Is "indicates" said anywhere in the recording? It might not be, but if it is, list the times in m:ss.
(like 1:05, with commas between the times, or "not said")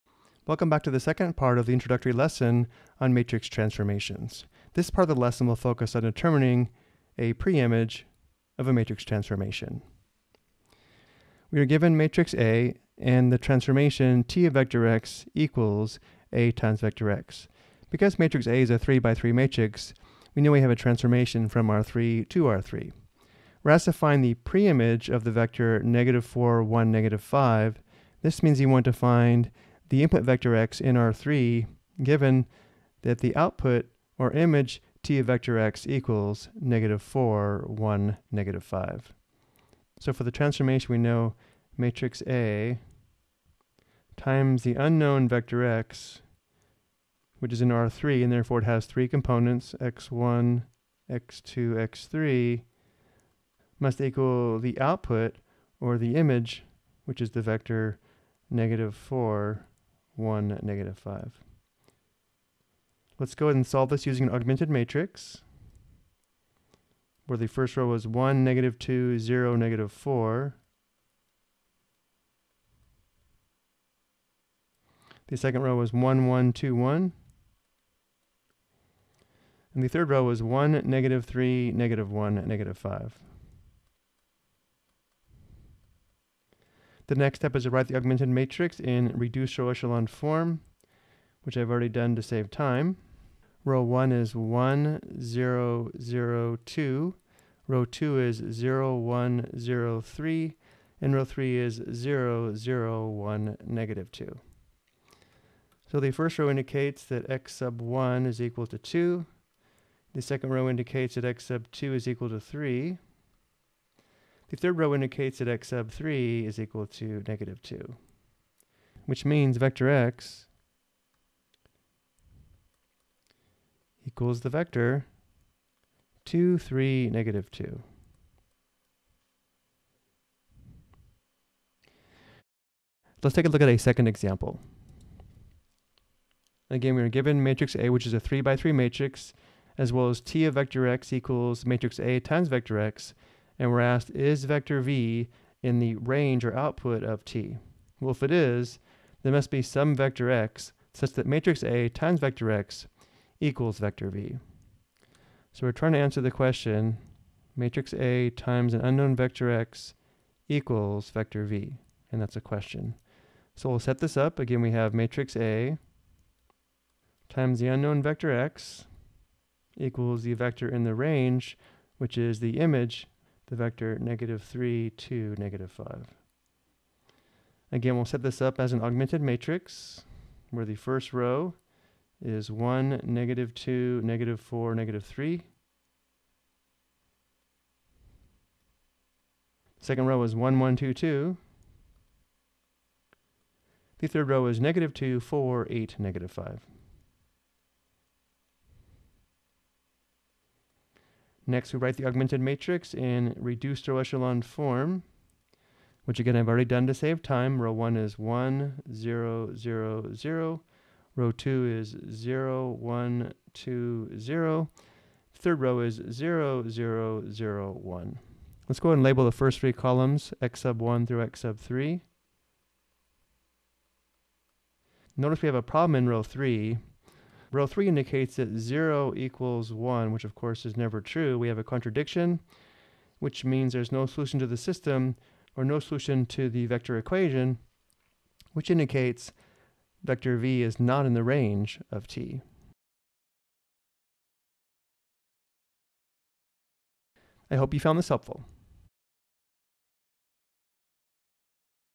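1:46, 1:50, 1:54, 3:47, 3:58.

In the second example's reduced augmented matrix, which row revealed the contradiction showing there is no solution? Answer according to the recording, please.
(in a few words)
Row 3.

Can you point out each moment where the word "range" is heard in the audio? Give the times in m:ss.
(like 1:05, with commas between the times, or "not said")
2:25, 2:50, 4:01.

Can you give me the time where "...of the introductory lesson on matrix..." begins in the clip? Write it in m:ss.
0:01.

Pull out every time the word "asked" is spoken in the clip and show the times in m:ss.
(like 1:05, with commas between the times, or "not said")
0:23, 2:23.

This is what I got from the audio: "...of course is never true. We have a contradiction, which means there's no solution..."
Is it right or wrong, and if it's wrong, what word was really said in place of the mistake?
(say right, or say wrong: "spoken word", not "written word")
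right.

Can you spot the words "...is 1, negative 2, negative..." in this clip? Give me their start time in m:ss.
3:02.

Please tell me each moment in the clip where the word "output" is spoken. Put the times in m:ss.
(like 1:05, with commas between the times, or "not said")
0:33, 0:54, 2:26.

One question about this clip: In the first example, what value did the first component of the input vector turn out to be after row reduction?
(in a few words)
2.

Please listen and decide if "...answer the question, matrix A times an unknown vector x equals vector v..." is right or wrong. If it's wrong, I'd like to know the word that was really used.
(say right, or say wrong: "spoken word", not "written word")
right.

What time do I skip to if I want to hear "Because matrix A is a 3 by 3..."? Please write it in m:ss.
0:17.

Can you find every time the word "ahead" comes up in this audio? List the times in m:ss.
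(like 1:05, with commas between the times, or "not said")
1:03, 3:38.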